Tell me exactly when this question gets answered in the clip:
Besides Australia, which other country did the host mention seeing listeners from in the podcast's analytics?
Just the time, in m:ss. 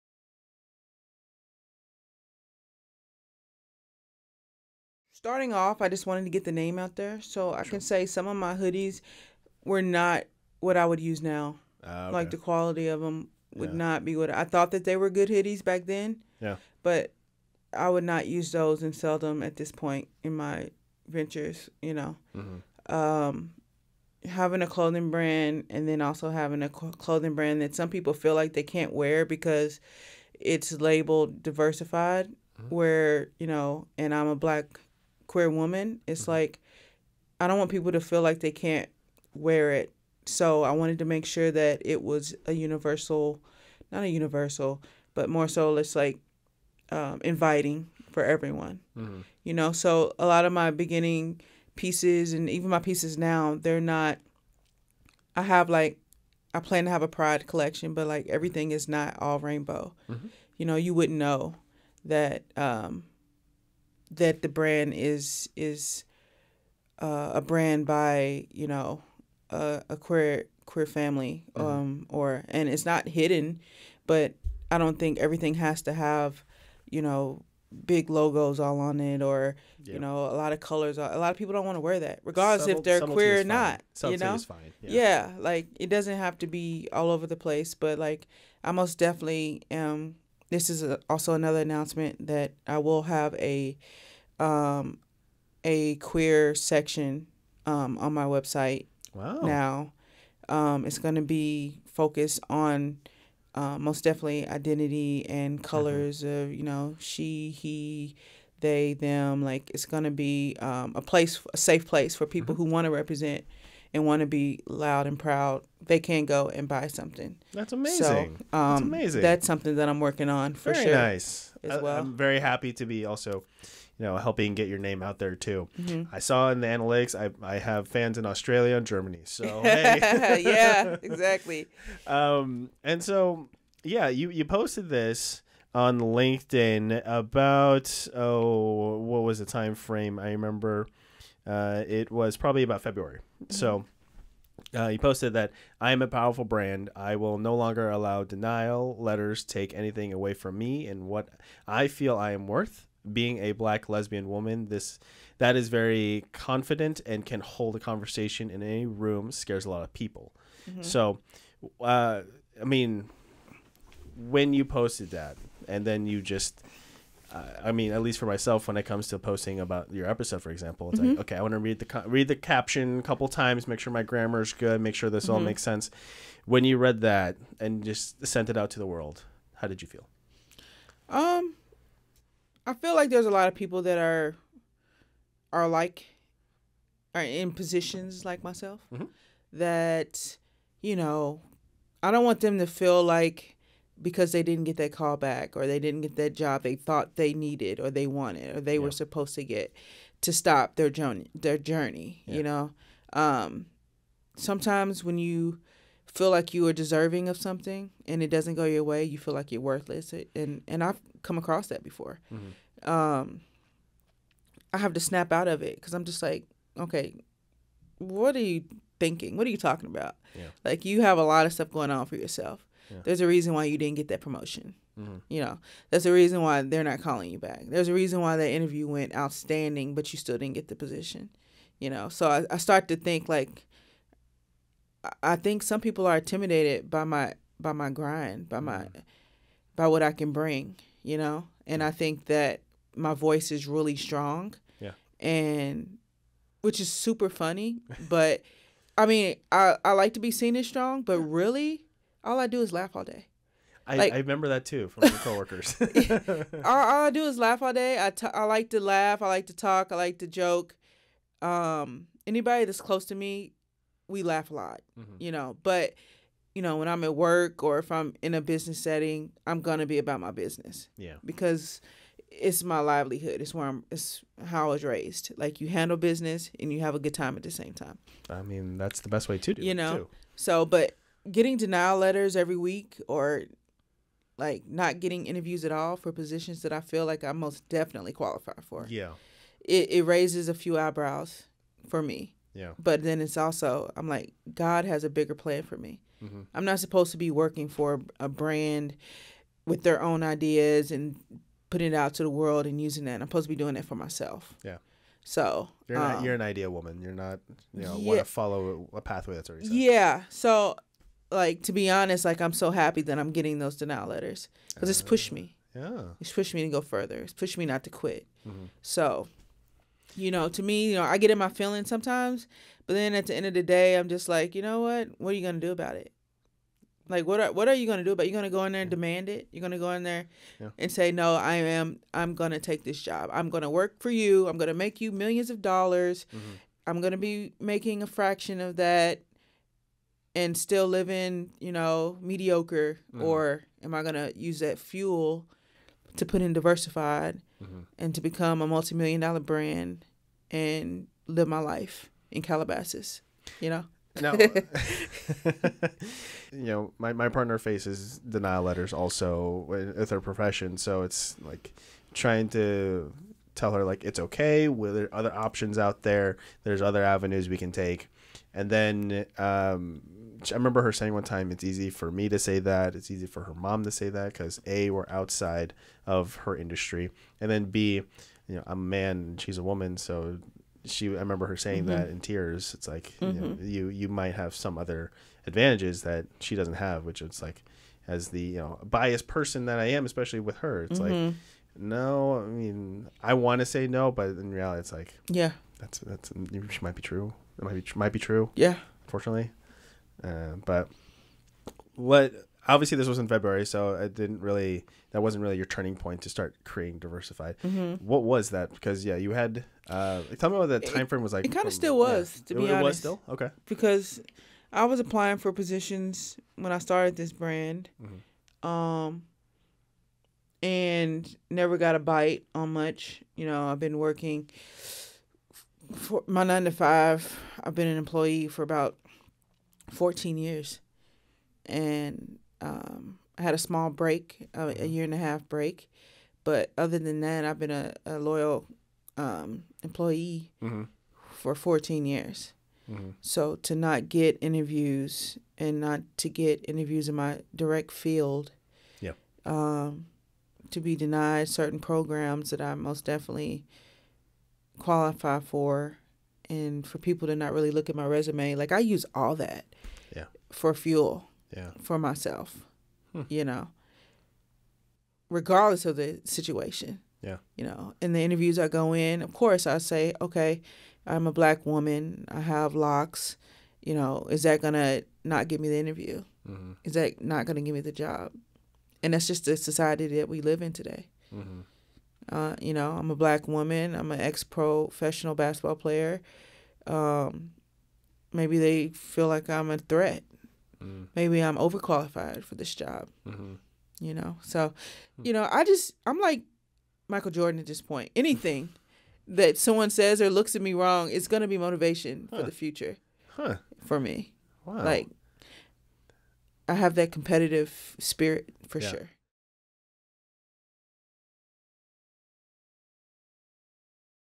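2:08.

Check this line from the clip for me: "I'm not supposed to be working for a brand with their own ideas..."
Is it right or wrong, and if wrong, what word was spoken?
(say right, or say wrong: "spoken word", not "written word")
right.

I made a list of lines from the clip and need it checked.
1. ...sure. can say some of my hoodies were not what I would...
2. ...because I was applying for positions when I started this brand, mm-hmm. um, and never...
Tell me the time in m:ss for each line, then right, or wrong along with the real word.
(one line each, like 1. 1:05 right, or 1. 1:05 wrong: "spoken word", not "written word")
1. 0:07 right
2. 6:53 right.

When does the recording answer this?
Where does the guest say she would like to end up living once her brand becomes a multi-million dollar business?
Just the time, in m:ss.
5:52.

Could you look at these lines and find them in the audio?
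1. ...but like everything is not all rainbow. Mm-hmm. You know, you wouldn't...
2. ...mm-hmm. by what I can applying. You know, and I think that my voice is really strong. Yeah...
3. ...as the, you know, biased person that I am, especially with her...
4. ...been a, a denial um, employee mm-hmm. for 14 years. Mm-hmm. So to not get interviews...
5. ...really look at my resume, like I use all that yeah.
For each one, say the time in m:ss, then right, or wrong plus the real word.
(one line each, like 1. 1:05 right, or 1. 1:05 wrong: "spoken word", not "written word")
1. 0:57 right
2. 3:58 wrong: "bring", not "applying"
3. 6:28 right
4. 7:17 wrong: "loyal", not "denial"
5. 7:37 right.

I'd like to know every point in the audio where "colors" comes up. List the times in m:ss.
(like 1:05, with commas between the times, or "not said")
1:20, 1:45.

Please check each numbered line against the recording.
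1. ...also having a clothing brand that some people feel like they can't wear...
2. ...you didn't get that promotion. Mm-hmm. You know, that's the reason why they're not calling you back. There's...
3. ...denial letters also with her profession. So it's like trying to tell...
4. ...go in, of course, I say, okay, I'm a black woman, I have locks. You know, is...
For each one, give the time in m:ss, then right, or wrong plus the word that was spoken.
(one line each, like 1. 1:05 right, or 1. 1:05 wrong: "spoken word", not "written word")
1. 0:26 right
2. 3:43 right
3. 5:58 right
4. 7:48 right.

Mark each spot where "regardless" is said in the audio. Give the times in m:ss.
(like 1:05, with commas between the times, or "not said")
1:22, 7:45.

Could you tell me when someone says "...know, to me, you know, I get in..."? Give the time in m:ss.
5:20.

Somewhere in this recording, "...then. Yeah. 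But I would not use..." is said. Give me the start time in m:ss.
0:15.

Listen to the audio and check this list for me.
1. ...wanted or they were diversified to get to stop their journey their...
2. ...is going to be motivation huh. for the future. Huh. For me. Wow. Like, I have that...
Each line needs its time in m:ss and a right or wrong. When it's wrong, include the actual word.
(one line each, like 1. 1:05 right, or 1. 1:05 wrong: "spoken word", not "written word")
1. 3:18 wrong: "supposed", not "diversified"
2. 8:21 right.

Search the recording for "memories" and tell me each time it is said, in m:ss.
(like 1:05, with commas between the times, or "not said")
not said.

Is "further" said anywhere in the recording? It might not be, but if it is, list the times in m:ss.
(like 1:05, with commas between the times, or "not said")
5:16.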